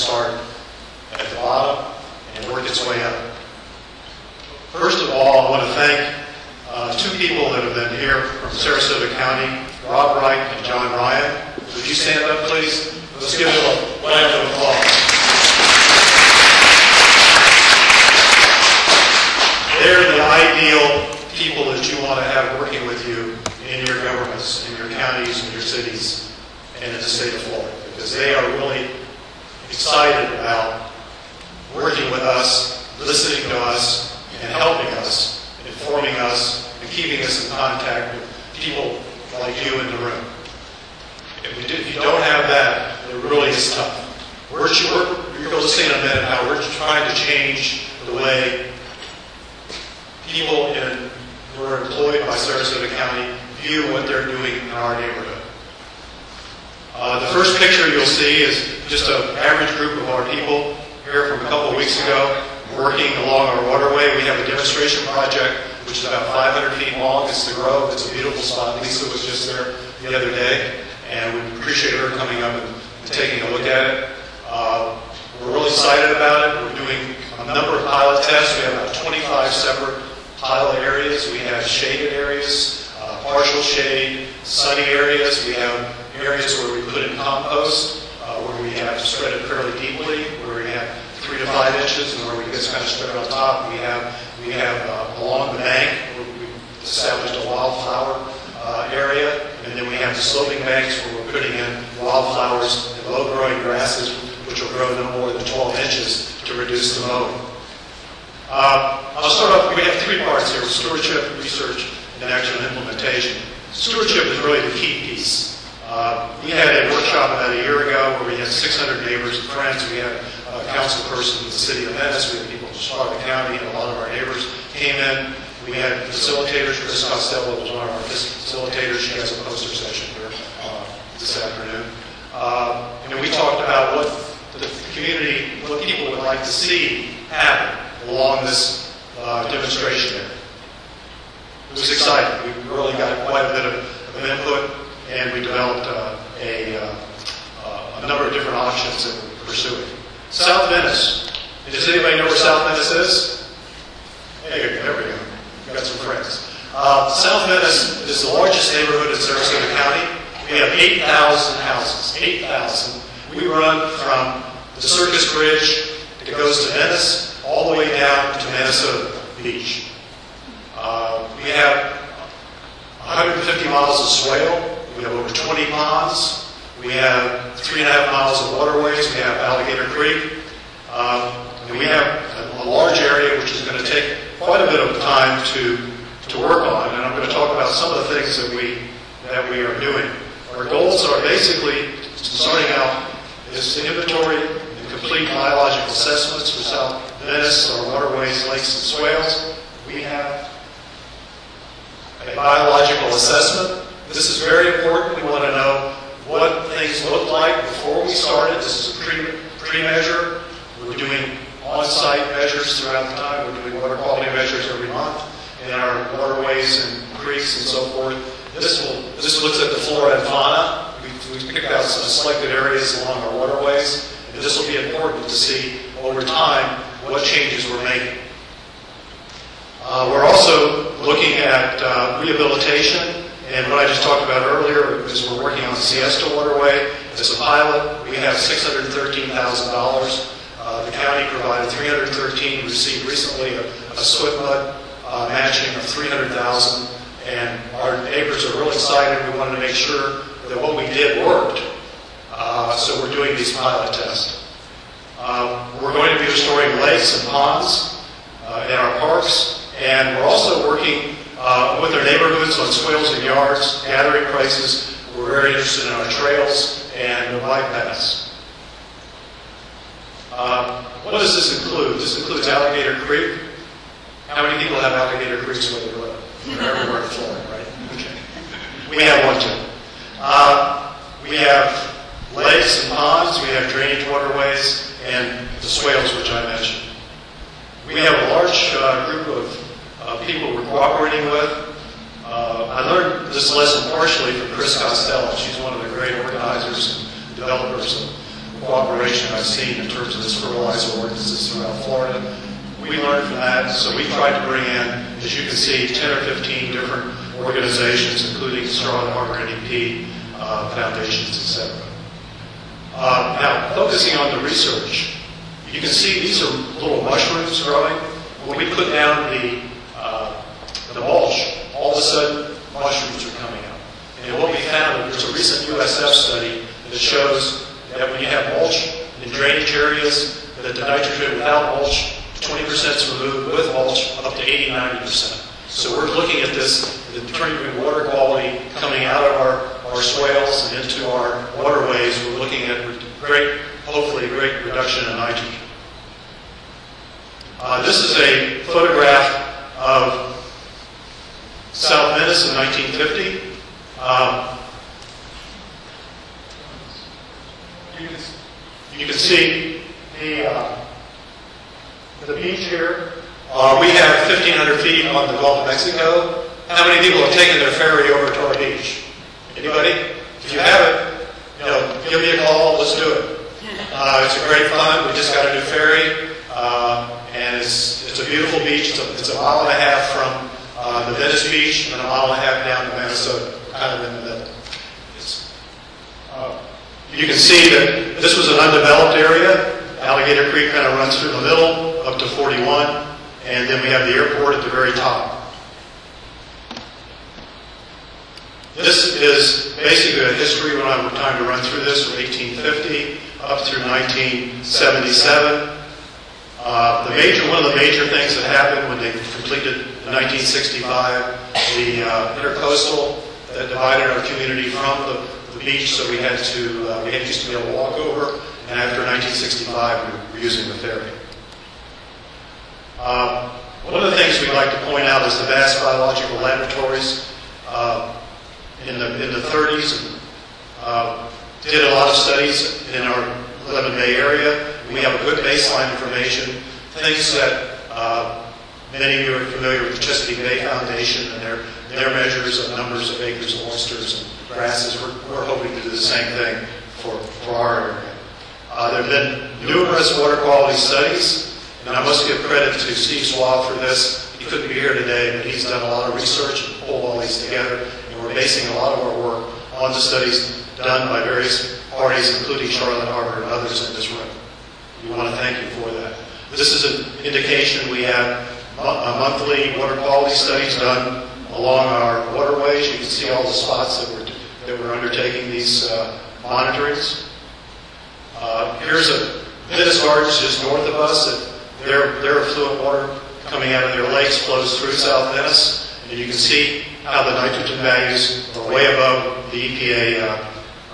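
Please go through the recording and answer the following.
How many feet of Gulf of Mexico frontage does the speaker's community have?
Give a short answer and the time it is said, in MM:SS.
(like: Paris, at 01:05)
1,500 feet, at 06:04.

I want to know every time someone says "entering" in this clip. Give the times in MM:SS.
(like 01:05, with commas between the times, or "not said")
not said.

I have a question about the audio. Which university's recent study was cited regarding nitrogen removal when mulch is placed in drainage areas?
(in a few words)
USF.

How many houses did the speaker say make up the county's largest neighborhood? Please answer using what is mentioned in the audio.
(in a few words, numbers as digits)
8,000.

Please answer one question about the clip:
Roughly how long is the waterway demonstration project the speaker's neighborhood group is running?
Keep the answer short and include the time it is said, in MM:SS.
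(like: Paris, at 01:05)
500 feet, at 01:06.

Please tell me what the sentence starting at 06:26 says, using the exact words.
Uh, you can see that this was an undeveloped area.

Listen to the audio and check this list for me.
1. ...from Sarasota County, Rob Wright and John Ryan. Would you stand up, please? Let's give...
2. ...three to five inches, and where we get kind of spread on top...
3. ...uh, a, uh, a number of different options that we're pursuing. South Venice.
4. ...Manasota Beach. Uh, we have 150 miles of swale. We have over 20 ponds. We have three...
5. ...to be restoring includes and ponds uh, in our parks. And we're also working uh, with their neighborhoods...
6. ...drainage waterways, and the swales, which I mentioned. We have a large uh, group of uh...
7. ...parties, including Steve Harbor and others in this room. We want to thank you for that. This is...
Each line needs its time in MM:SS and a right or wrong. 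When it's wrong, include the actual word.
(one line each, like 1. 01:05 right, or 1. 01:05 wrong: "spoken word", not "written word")
1. 00:08 right
2. 01:31 right
3. 02:25 right
4. 02:48 right
5. 04:16 wrong: "lakes", not "includes"
6. 04:43 right
7. 07:41 wrong: "Charlotte", not "Steve".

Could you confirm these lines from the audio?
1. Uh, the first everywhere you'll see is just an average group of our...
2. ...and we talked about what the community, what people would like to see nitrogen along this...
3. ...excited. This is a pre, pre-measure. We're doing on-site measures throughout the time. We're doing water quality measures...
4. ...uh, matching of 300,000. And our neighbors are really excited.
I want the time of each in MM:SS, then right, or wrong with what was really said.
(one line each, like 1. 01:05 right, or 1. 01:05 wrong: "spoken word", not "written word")
1. 00:56 wrong: "picture", not "everywhere"
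2. 02:13 wrong: "happen", not "nitrogen"
3. 03:28 wrong: "started", not "excited"
4. 04:05 right.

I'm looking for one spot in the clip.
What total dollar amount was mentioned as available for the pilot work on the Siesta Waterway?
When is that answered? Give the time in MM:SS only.
03:58.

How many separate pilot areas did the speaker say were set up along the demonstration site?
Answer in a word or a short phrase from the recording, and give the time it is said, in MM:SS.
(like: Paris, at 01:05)
25, at 01:18.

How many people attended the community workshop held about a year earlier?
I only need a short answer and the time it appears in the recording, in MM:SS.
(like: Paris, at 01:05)
600, at 01:58.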